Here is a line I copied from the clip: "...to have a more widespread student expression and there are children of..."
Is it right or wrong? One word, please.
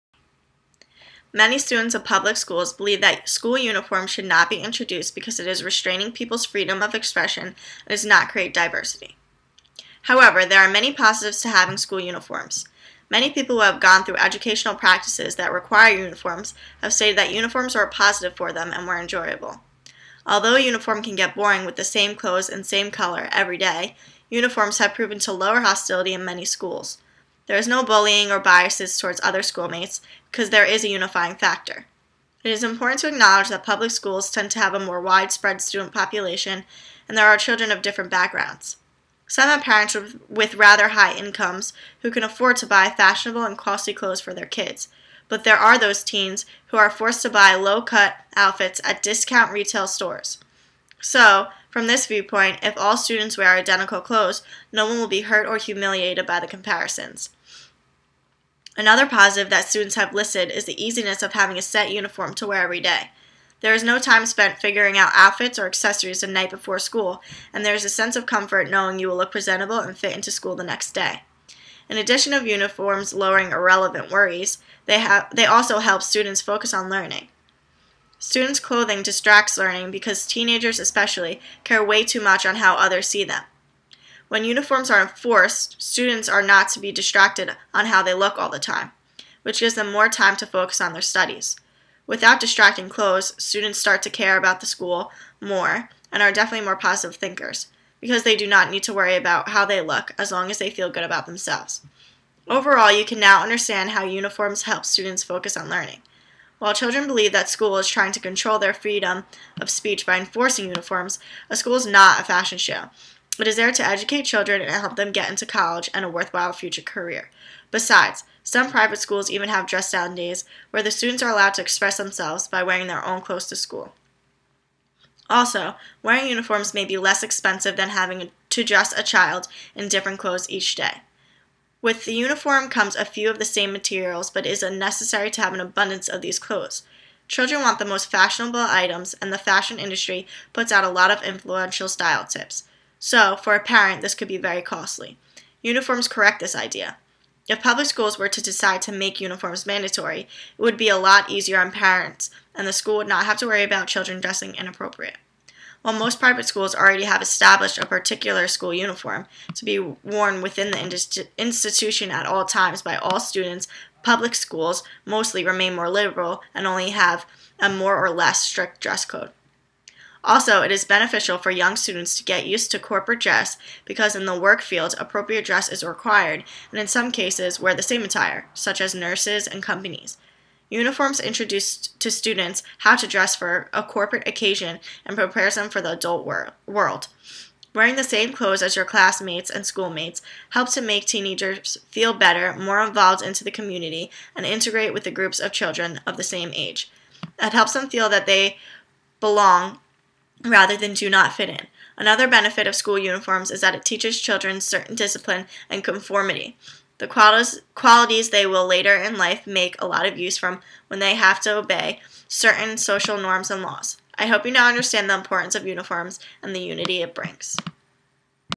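wrong.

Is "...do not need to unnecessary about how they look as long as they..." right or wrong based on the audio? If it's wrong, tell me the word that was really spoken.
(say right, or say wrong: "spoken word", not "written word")
wrong: "worry", not "unnecessary".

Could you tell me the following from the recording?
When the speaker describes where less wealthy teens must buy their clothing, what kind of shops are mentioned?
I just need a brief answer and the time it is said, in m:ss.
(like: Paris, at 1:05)
discount retail stores, at 0:49.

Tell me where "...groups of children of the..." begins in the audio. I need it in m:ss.
3:15.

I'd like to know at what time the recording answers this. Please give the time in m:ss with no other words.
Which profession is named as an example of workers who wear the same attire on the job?
2:58.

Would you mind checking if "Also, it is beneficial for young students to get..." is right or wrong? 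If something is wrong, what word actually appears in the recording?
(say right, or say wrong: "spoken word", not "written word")
right.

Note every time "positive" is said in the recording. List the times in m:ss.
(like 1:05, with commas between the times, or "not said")
0:10, 0:17, 0:59, 1:36.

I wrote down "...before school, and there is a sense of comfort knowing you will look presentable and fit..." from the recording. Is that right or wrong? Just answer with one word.
right.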